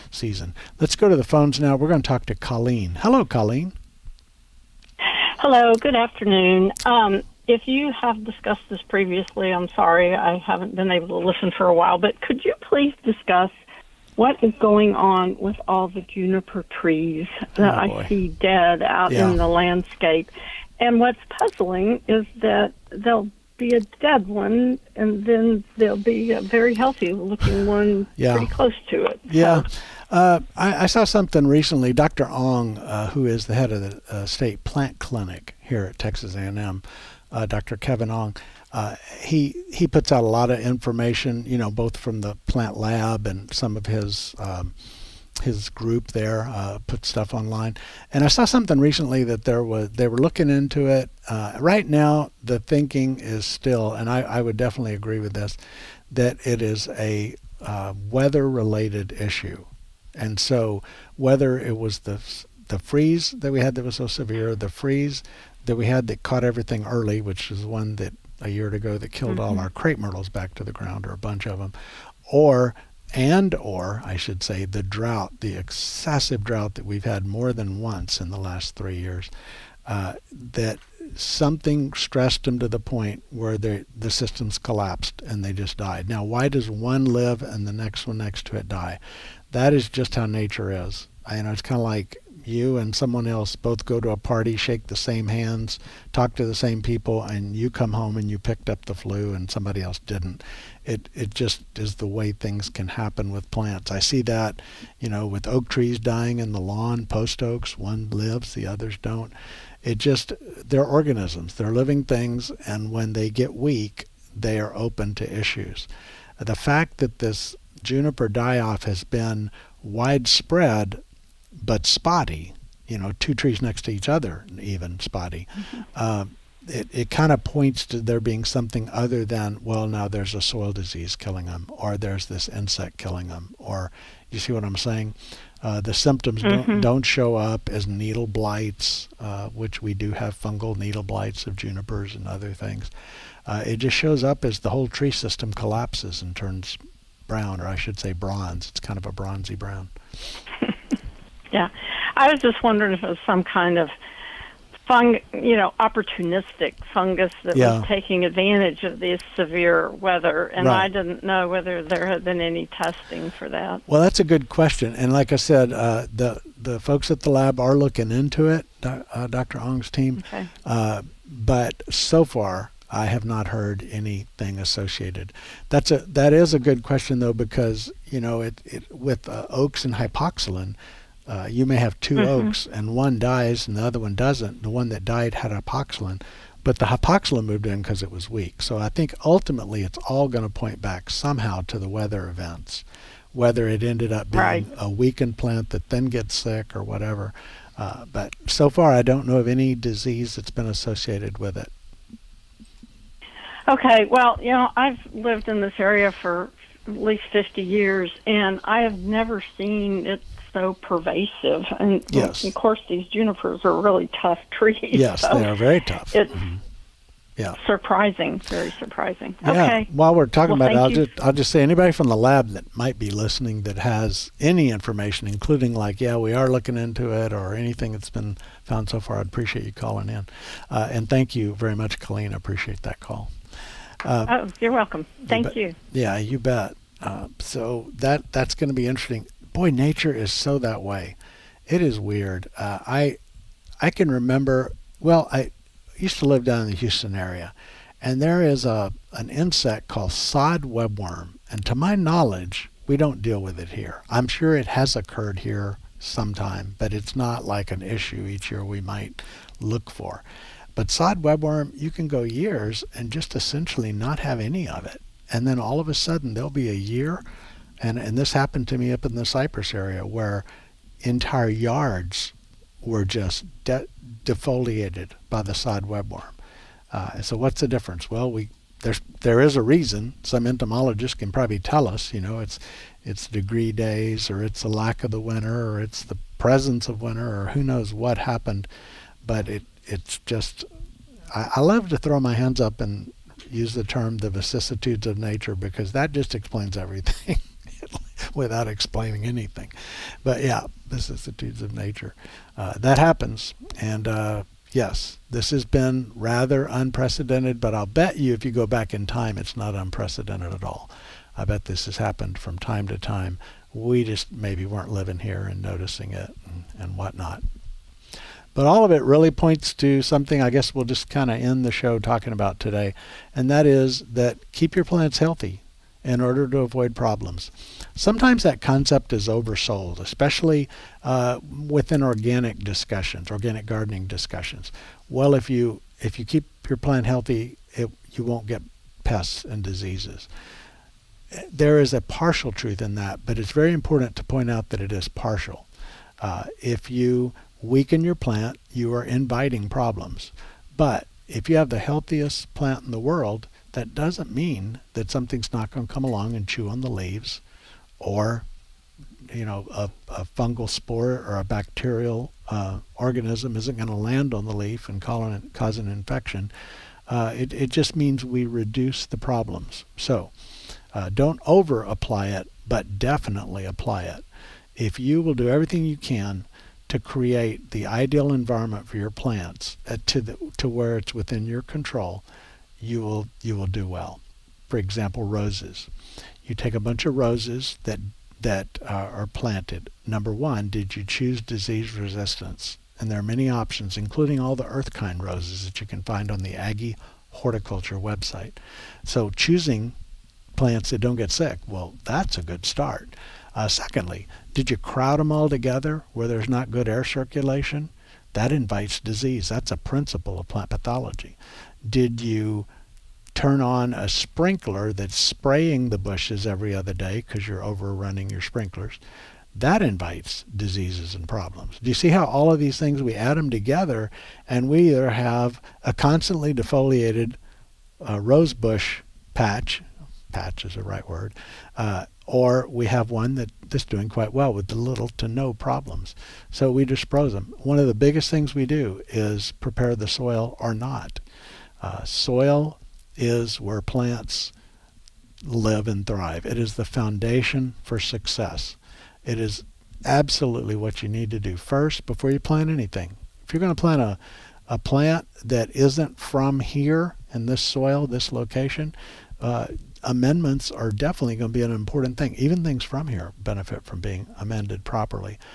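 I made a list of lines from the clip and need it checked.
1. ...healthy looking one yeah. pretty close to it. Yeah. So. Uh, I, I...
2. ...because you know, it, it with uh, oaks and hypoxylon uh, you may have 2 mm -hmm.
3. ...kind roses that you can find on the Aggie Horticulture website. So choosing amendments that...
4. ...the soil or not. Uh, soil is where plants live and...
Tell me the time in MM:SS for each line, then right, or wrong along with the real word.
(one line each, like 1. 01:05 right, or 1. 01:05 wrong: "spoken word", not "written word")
1. 00:26 right
2. 02:57 right
3. 06:34 wrong: "plants", not "amendments"
4. 07:19 right.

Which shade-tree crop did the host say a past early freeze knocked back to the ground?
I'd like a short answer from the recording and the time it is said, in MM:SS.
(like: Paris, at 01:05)
crepe myrtles, at 01:09.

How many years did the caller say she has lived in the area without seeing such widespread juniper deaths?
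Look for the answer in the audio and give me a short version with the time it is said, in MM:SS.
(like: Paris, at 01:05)
50, at 03:27.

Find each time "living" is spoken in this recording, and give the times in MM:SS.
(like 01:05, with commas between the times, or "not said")
01:51, 05:14.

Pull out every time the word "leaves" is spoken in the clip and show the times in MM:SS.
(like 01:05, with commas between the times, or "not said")
05:56.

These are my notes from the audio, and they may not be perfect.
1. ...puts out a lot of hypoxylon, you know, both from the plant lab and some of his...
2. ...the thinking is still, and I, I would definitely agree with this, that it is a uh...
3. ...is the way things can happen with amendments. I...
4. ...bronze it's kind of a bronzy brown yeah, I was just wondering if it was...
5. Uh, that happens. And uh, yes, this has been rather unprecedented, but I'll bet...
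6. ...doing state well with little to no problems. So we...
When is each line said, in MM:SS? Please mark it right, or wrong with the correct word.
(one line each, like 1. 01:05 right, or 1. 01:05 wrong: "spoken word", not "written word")
1. 00:39 wrong: "information", not "hypoxylon"
2. 00:52 right
3. 01:41 wrong: "plants", not "amendments"
4. 02:28 right
5. 05:02 right
6. 07:13 wrong: "quite", not "state".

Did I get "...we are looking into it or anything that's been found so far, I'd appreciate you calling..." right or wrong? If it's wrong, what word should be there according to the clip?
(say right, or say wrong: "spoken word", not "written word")
right.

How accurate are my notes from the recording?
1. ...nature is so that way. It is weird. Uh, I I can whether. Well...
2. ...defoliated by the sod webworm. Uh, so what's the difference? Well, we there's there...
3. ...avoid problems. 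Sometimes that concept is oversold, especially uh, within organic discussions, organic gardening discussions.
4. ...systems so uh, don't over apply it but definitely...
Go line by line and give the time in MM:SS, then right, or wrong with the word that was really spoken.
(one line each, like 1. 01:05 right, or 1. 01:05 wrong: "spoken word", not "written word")
1. 03:59 wrong: "remember", not "whether"
2. 04:34 right
3. 05:26 right
4. 06:09 wrong: "problems", not "systems".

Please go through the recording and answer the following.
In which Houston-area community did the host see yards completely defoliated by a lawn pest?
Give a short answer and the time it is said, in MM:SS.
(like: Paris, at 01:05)
Cypress, at 04:29.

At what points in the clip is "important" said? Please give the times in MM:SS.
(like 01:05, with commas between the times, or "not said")
05:43, 07:41.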